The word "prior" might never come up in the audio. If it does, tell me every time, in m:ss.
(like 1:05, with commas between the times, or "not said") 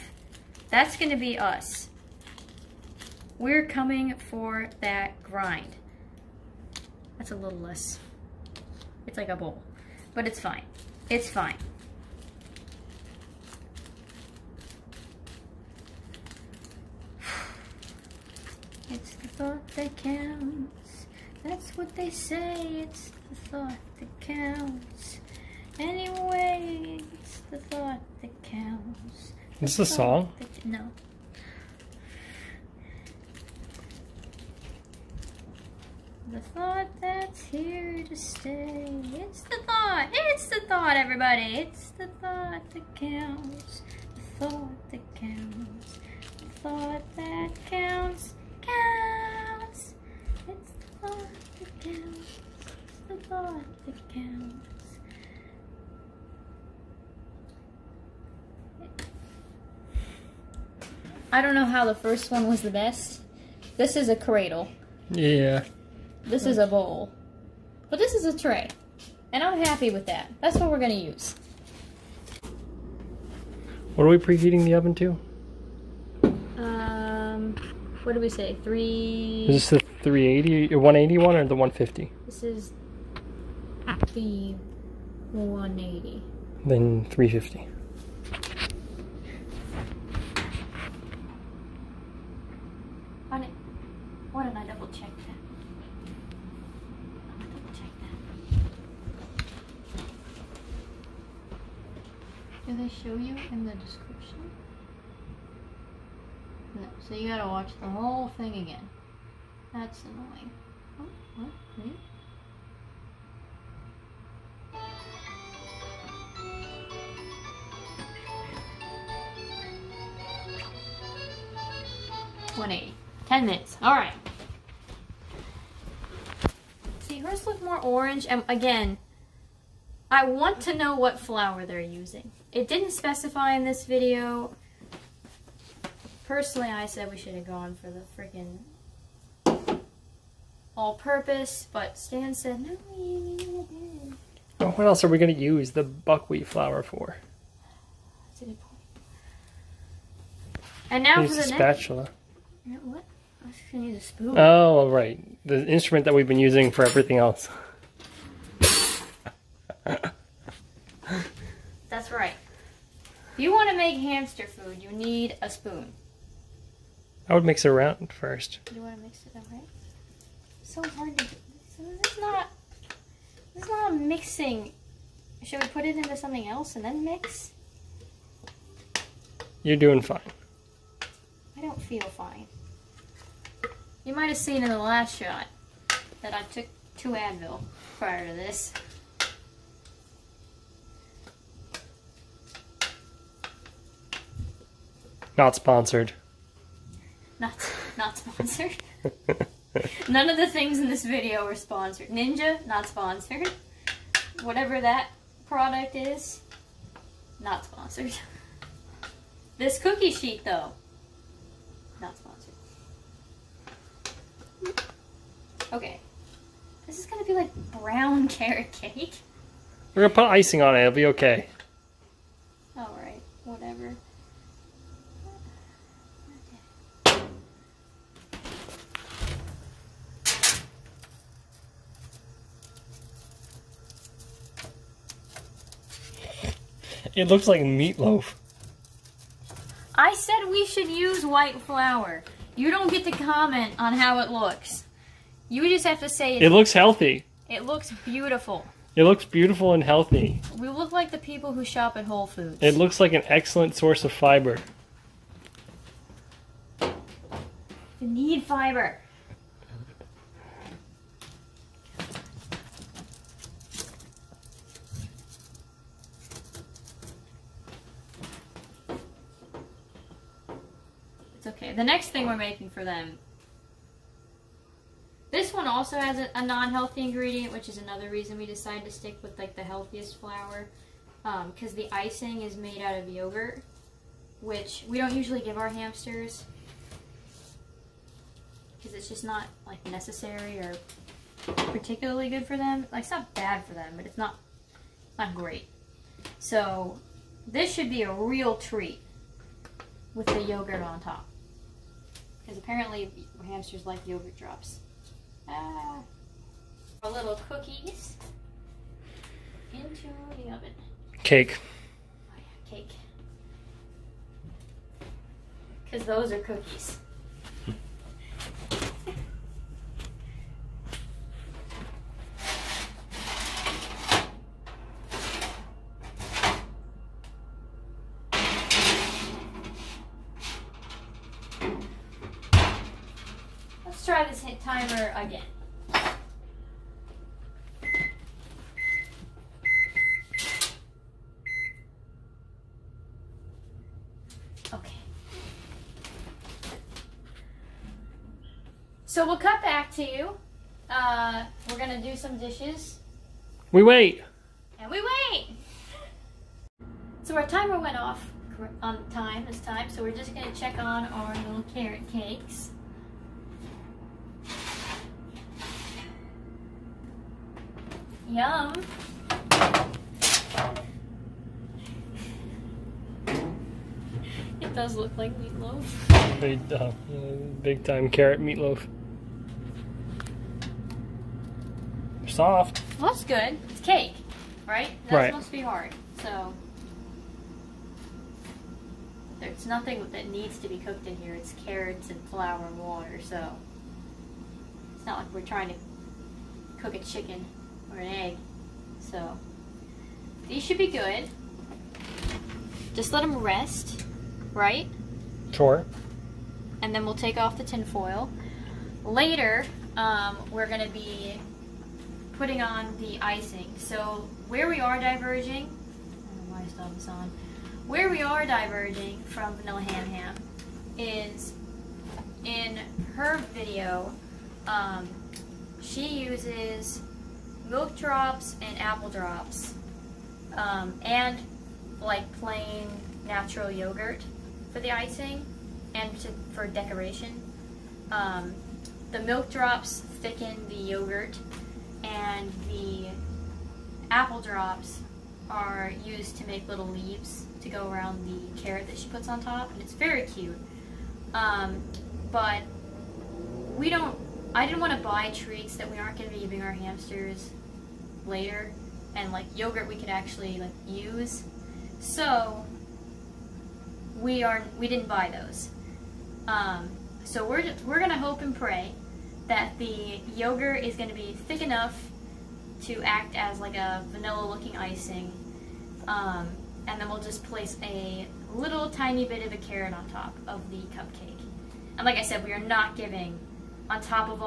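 3:07.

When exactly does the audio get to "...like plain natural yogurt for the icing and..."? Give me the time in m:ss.
7:12.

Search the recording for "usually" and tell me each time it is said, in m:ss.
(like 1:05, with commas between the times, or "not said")
4:45.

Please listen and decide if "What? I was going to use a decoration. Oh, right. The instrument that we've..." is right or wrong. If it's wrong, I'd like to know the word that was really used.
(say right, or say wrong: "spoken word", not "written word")
wrong: "spoon", not "decoration".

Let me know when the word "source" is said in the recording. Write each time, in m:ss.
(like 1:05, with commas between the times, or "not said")
4:13.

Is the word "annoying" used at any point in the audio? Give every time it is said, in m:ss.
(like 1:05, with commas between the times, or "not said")
1:50.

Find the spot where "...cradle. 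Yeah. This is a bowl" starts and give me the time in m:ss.
1:04.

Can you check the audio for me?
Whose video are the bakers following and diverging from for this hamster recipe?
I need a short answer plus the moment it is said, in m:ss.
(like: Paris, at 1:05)
Vanilla Ham Ham, at 6:59.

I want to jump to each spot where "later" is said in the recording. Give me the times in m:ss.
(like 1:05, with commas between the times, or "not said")
6:49, 7:38.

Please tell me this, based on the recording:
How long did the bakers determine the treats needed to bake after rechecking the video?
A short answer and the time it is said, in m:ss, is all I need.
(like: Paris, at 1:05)
10 minutes, at 2:03.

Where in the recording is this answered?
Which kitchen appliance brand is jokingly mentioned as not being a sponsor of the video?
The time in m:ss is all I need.
3:22.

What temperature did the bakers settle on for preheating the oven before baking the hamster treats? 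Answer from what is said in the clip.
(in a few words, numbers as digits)
180.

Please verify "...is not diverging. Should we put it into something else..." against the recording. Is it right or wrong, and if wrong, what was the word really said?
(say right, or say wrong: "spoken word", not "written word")
wrong: "mixing", not "diverging".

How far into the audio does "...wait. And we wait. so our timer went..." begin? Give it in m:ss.
5:53.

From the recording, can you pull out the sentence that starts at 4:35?
This one also has a, a non-healthy ingredient, which is another reason we decided to stick with like the healthiest flour.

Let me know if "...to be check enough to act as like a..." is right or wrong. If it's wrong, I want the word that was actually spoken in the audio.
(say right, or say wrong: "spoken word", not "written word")
wrong: "thick", not "check".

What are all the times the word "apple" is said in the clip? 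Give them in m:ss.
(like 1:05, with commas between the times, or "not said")
7:08, 7:24.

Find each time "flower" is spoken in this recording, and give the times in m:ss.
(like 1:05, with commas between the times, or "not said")
2:11.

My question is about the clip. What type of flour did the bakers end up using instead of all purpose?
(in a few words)
Buckwheat flour.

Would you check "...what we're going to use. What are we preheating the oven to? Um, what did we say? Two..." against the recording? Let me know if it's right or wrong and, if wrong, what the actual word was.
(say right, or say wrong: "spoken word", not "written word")
wrong: "Three", not "Two".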